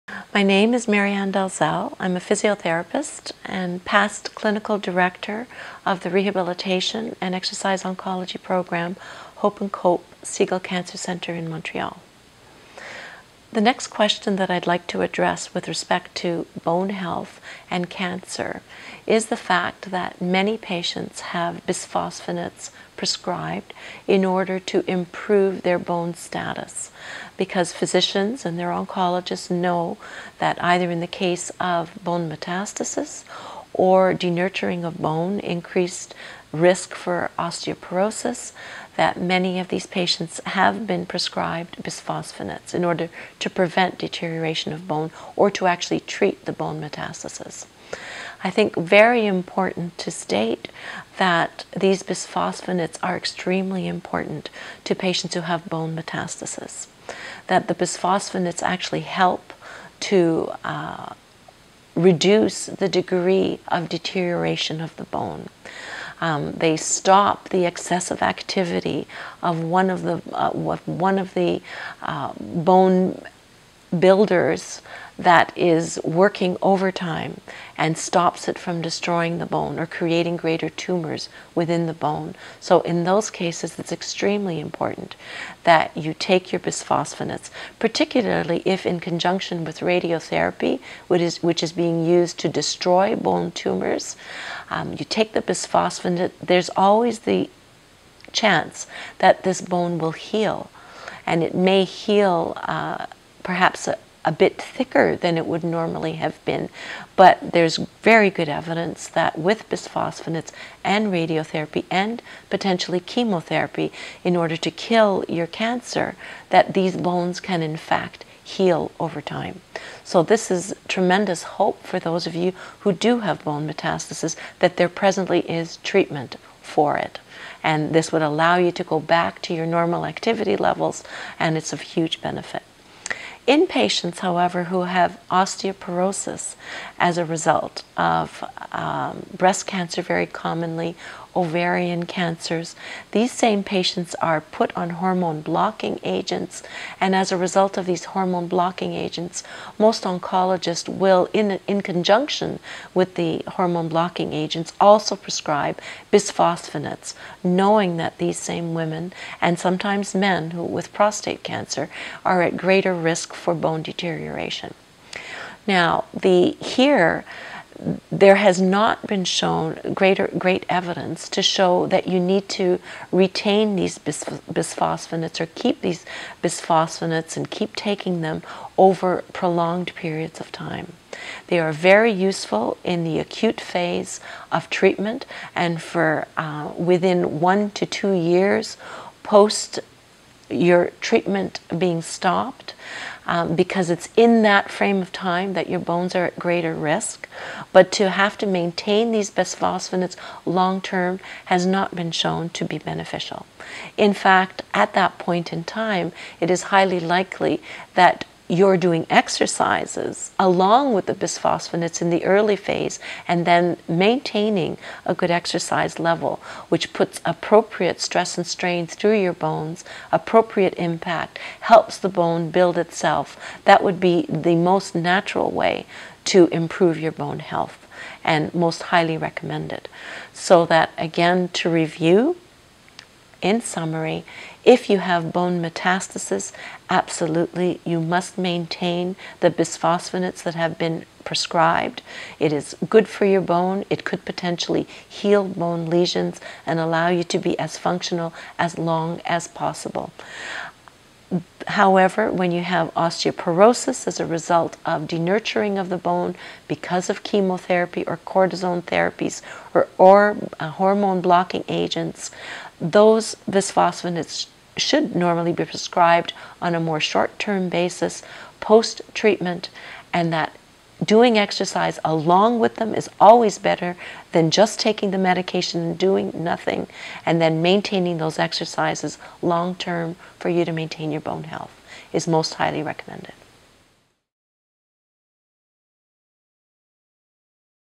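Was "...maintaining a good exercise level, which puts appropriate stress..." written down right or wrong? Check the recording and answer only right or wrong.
right.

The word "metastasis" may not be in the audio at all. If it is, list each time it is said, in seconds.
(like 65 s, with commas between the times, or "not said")
32 s, 46 s, 55 s, 123 s, 235 s.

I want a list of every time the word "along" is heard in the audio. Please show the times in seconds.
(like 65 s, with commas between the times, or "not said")
210 s, 272 s.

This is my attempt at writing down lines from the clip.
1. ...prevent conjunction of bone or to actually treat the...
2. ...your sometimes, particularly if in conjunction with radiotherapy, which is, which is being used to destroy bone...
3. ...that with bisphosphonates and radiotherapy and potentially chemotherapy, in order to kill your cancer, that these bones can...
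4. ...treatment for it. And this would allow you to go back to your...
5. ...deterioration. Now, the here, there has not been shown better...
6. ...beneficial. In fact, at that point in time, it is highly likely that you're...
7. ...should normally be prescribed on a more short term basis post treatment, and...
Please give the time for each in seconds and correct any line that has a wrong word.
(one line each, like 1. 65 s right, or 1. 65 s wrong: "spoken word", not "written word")
1. 43 s wrong: "deterioration", not "conjunction"
2. 86 s wrong: "bisphosphonates", not "sometimes"
3. 109 s right
4. 125 s right
5. 163 s wrong: "greater", not "better"
6. 202 s right
7. 264 s right.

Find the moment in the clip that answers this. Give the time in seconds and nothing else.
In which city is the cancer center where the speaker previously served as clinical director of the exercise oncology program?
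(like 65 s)
11 s.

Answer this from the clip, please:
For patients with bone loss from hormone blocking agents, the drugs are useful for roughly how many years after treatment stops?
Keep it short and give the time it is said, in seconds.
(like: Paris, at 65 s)
1 to 2 years, at 187 s.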